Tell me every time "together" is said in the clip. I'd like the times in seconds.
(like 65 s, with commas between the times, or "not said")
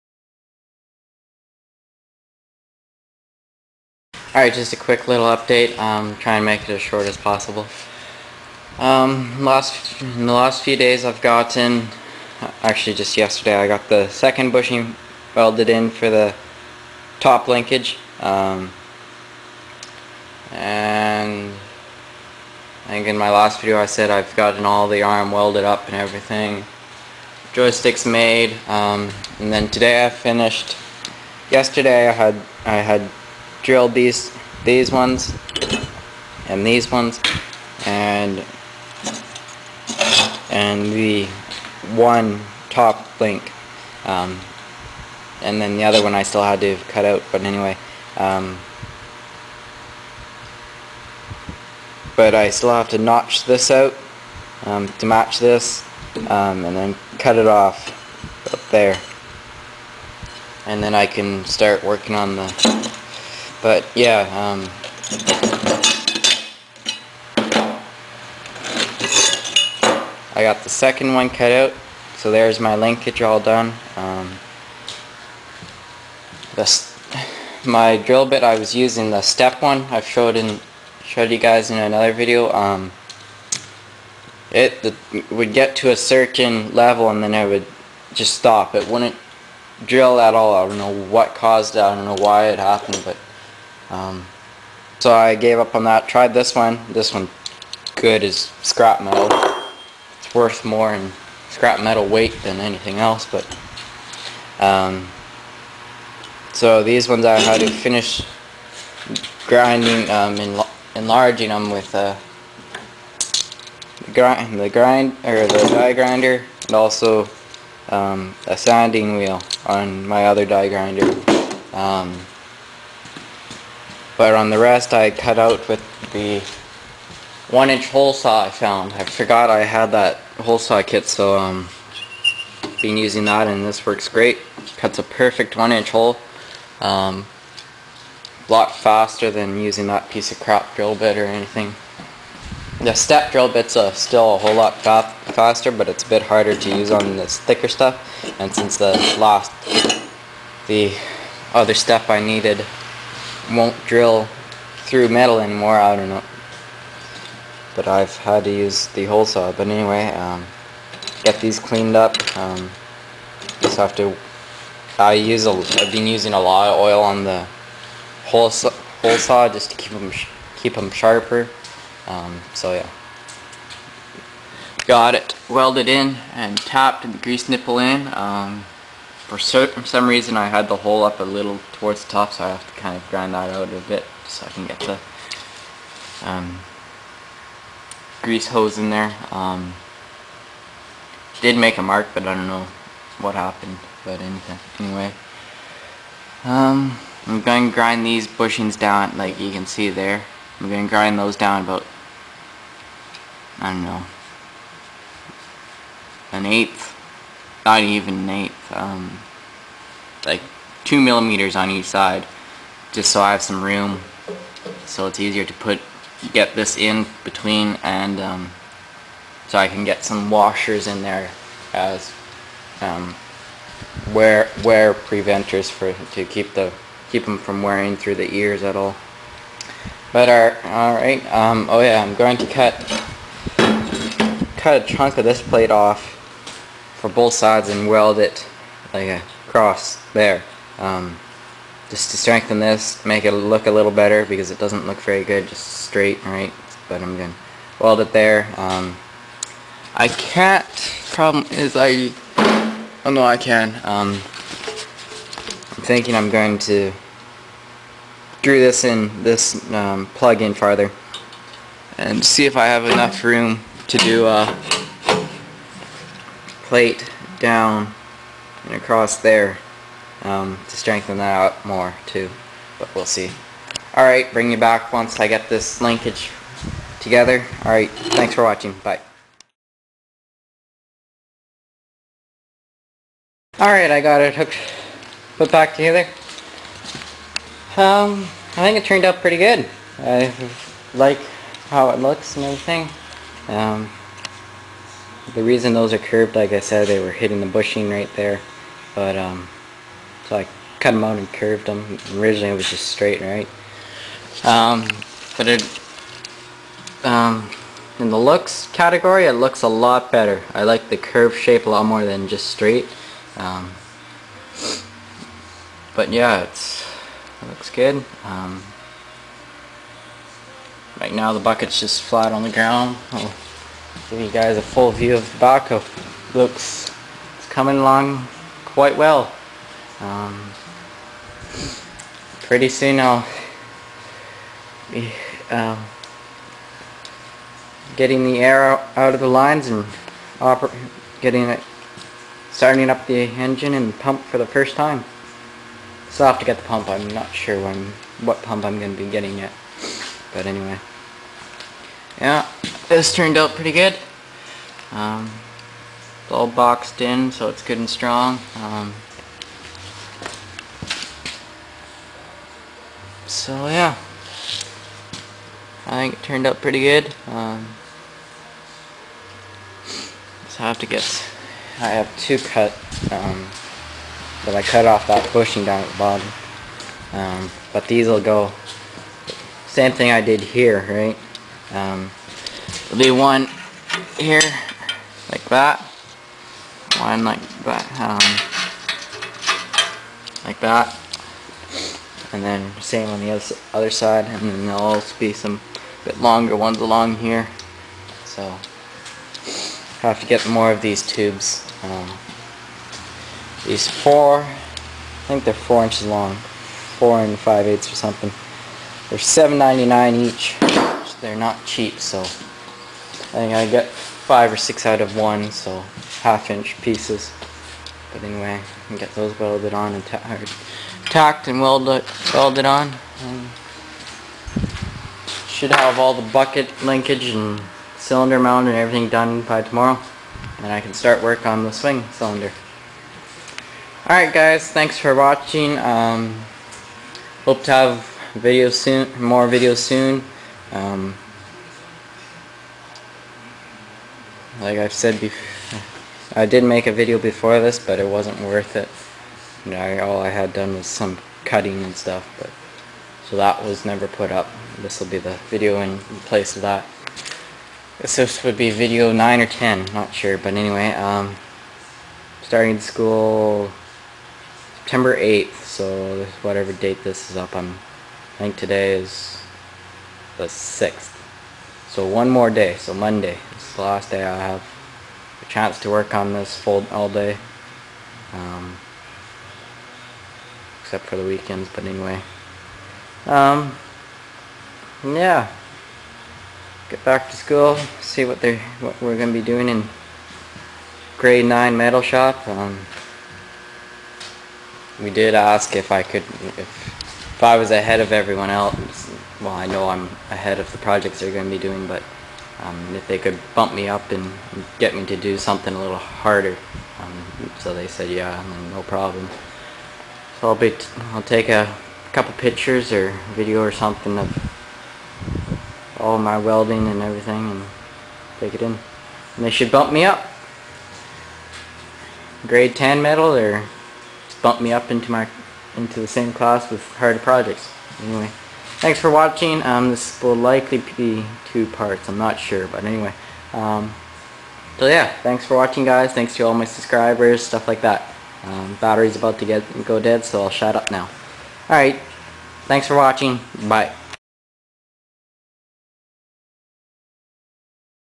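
277 s, 285 s.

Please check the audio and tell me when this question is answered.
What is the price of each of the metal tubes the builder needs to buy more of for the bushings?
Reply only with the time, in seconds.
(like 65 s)
409 s.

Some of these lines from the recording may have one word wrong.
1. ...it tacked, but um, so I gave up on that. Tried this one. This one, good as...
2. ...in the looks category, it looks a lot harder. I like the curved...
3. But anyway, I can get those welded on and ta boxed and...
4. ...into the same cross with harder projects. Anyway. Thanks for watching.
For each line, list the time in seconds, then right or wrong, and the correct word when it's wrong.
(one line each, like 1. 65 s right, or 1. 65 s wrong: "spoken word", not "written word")
1. 92 s wrong: "happened", not "tacked"
2. 307 s wrong: "better", not "harder"
3. 418 s wrong: "tacked", not "boxed"
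4. 525 s wrong: "class", not "cross".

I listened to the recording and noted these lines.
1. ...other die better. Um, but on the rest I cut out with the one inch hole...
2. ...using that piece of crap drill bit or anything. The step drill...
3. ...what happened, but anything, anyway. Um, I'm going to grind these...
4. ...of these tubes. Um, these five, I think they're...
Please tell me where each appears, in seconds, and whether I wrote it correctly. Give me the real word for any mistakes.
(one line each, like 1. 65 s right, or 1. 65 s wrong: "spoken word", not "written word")
1. 120 s wrong: "grinder", not "better"
2. 139 s right
3. 193 s right
4. 400 s wrong: "four", not "five".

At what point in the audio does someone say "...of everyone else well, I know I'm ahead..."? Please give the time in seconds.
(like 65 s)
497 s.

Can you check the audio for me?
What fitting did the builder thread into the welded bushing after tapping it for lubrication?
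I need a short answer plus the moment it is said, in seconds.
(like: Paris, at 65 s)
grease nipple, at 177 s.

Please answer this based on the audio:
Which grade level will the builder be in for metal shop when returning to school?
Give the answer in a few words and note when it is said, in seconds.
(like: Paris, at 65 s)
grade 9, at 491 s.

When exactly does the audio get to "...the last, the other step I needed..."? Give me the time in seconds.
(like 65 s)
148 s.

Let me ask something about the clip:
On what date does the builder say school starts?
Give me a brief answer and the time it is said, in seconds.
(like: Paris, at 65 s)
September 8, at 464 s.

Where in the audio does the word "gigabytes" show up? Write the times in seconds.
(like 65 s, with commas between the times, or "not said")
not said.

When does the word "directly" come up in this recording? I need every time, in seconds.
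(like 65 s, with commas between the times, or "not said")
not said.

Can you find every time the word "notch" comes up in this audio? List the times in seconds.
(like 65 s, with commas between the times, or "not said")
52 s.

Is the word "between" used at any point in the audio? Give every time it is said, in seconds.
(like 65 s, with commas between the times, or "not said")
217 s.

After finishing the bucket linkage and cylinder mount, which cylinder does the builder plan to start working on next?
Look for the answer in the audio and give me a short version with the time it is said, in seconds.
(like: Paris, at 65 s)
swing cylinder, at 431 s.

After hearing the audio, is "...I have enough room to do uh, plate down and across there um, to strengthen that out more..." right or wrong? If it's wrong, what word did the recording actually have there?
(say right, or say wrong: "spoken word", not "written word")
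right.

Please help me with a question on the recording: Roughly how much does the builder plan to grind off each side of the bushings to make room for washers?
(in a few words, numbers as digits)
2 millimeters.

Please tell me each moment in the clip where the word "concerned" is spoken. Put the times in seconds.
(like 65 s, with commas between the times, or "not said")
not said.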